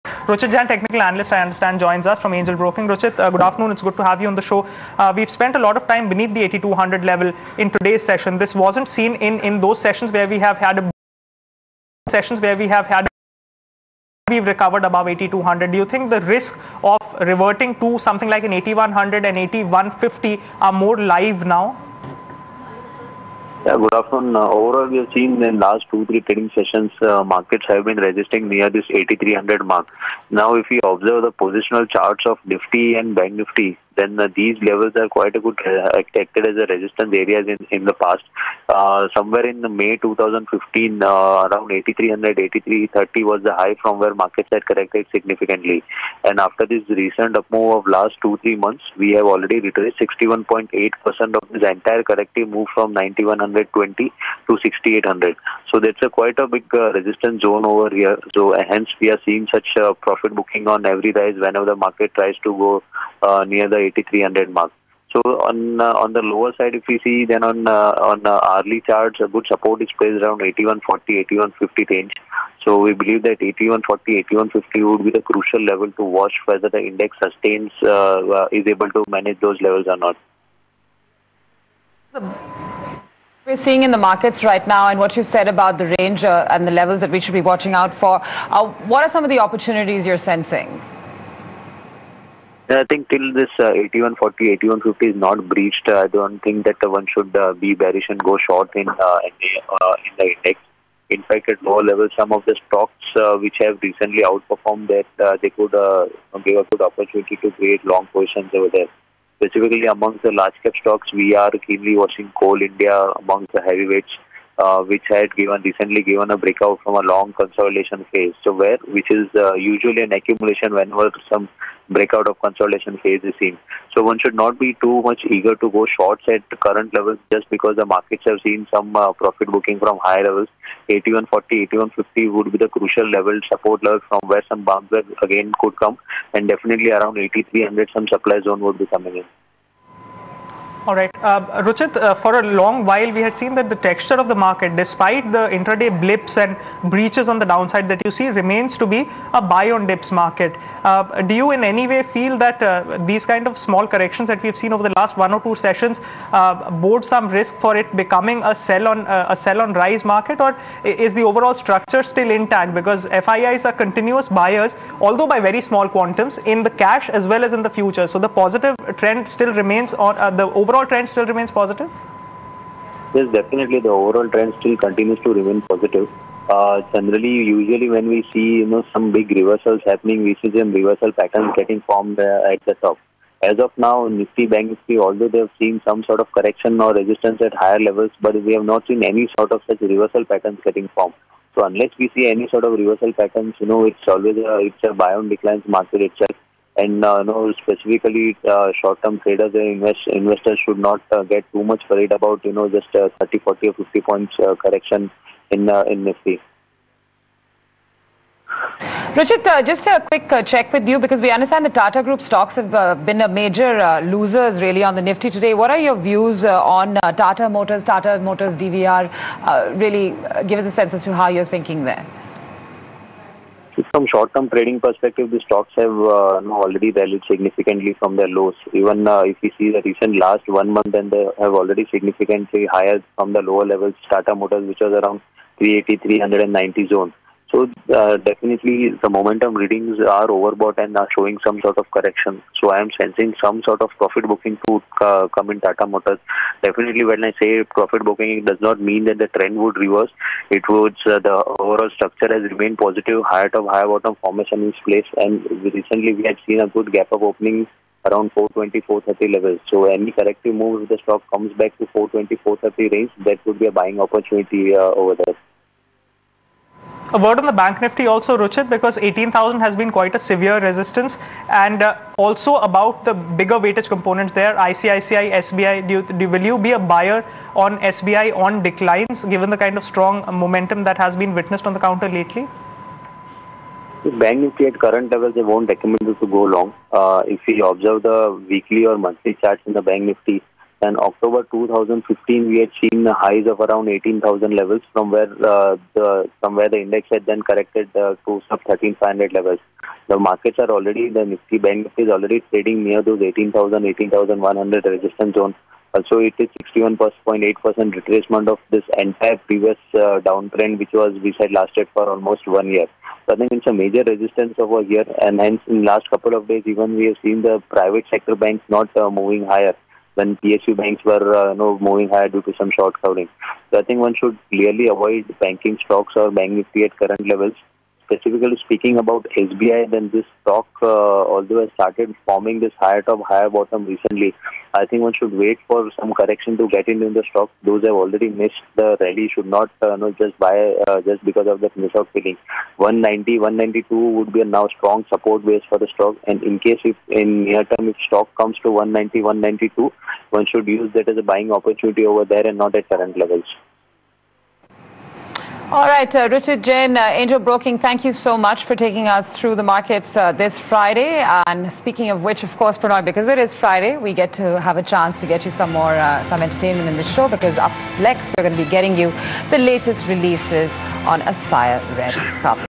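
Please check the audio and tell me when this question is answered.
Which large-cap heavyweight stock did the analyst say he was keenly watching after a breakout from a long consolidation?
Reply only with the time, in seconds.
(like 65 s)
112 s.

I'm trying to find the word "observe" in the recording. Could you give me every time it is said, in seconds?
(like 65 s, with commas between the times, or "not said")
30 s, 287 s.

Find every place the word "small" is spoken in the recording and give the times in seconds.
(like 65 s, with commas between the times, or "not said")
153 s, 165 s.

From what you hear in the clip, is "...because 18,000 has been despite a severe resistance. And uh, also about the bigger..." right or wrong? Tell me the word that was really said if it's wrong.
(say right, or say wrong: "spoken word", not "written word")
wrong: "quite", not "despite".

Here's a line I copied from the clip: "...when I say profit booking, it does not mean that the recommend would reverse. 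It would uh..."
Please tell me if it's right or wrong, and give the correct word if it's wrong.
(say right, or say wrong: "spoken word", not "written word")
wrong: "trend", not "recommend".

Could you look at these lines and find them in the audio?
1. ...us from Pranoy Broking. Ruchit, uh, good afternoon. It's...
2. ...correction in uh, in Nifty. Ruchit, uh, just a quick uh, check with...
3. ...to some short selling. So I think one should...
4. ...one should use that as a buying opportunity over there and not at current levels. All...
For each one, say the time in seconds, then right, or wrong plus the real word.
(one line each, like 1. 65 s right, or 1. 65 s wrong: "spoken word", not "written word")
1. 2 s wrong: "Angel", not "Pranoy"
2. 204 s right
3. 322 s right
4. 350 s right.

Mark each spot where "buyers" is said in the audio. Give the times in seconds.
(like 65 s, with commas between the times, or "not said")
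164 s, 276 s.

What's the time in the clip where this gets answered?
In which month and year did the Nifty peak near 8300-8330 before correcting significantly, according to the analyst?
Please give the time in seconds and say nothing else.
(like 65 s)
39 s.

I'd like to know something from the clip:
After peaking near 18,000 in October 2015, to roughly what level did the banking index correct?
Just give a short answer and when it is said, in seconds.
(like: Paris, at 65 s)
sub 13,500, at 298 s.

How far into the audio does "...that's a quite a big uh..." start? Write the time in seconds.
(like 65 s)
55 s.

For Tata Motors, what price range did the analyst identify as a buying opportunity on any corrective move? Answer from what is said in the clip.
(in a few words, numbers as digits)
420-430.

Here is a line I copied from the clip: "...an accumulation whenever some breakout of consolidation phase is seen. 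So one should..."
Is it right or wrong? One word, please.
right.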